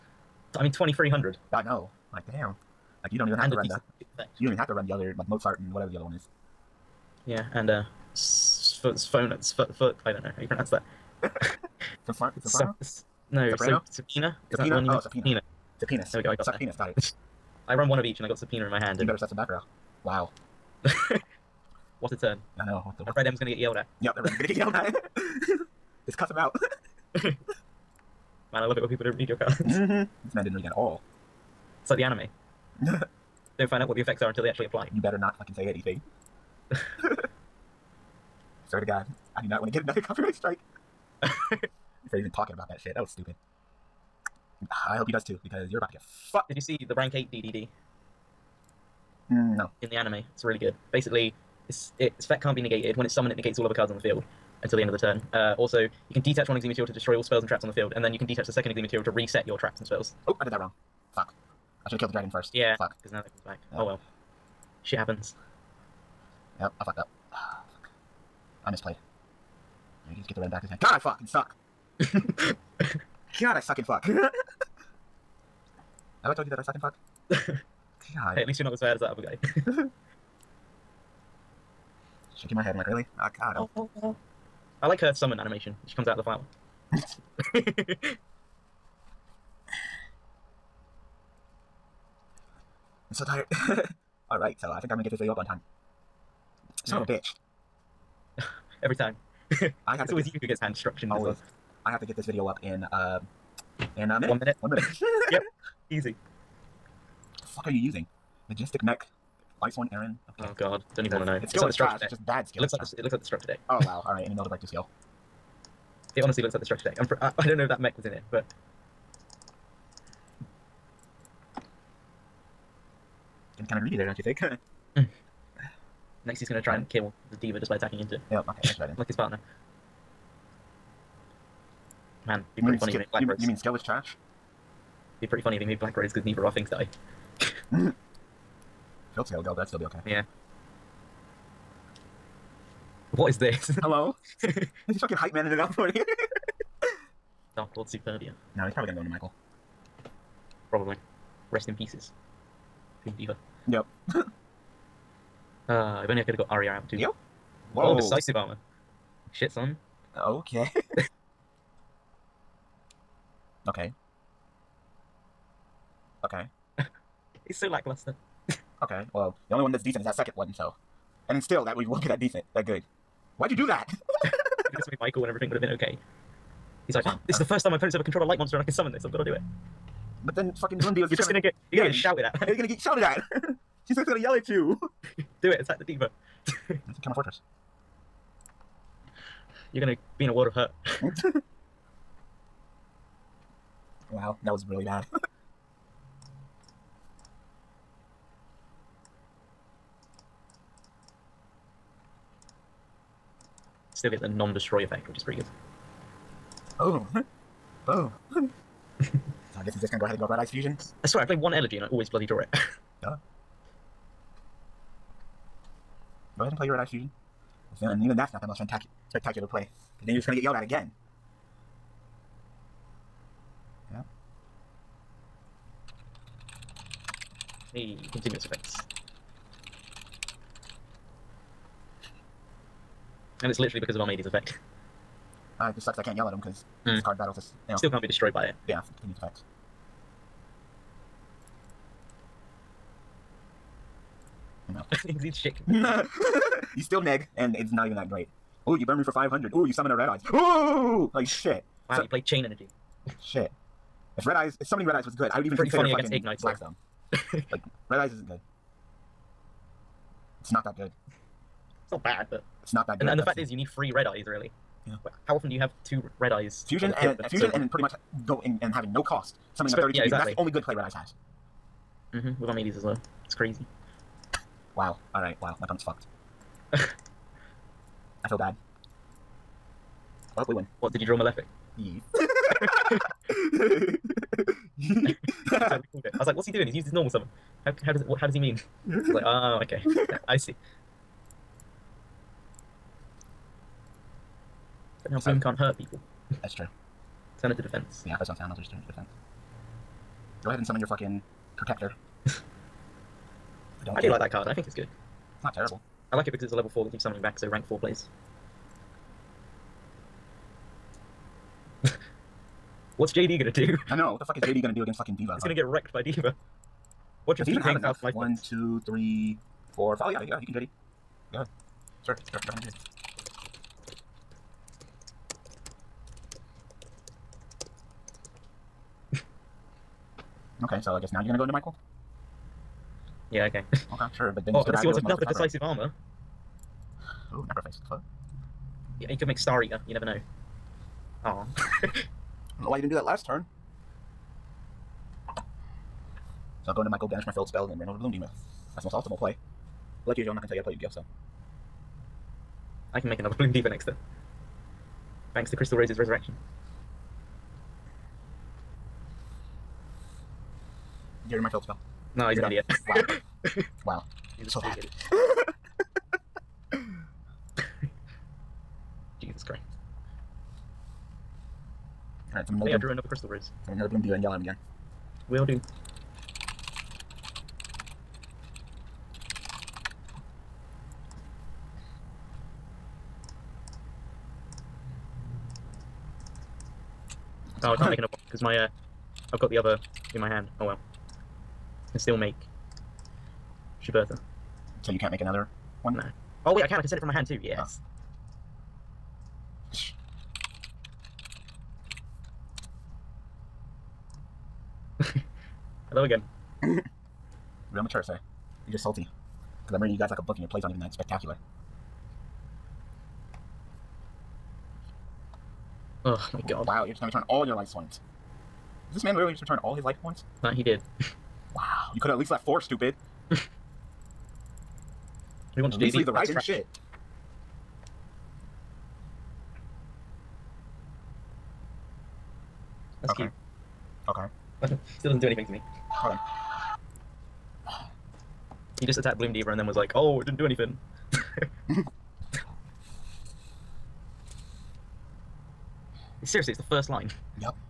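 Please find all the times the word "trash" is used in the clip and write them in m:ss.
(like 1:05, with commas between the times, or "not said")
1:51, 2:13.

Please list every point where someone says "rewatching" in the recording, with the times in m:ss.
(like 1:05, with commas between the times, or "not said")
not said.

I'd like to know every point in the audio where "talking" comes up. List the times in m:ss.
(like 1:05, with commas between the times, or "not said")
0:42.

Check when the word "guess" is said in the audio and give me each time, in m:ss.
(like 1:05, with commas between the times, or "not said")
3:29, 5:30.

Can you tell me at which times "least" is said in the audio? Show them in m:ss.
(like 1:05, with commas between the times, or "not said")
1:18, 7:02.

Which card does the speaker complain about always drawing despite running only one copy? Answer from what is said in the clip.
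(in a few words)
Elegy.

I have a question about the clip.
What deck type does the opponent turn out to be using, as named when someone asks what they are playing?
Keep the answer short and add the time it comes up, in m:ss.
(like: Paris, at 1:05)
Majestic Mech, at 1:48.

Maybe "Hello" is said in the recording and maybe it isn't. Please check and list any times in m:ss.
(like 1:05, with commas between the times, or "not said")
2:23, 6:45.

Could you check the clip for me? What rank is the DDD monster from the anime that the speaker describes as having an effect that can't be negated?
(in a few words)
8.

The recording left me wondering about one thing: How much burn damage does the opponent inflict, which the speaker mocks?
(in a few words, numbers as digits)
500.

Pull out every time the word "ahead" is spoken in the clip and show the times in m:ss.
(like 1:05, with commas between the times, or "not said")
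3:30, 3:36, 5:00, 5:22.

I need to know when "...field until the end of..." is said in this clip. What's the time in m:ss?
0:54.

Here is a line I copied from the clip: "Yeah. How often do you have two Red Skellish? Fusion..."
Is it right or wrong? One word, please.
wrong.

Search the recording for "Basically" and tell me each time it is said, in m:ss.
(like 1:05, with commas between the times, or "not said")
0:50.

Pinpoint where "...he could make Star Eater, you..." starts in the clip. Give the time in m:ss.
5:39.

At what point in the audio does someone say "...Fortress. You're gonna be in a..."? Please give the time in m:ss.
3:07.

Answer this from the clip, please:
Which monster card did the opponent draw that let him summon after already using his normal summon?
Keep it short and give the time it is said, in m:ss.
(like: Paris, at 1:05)
Malefic, at 4:41.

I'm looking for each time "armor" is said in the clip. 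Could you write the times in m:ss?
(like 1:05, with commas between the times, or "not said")
2:38, 5:35.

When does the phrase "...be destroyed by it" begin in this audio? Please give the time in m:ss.
3:58.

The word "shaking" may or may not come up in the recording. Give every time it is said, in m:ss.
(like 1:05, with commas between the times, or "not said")
1:22, 4:05.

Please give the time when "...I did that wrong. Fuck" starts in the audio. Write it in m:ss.
1:00.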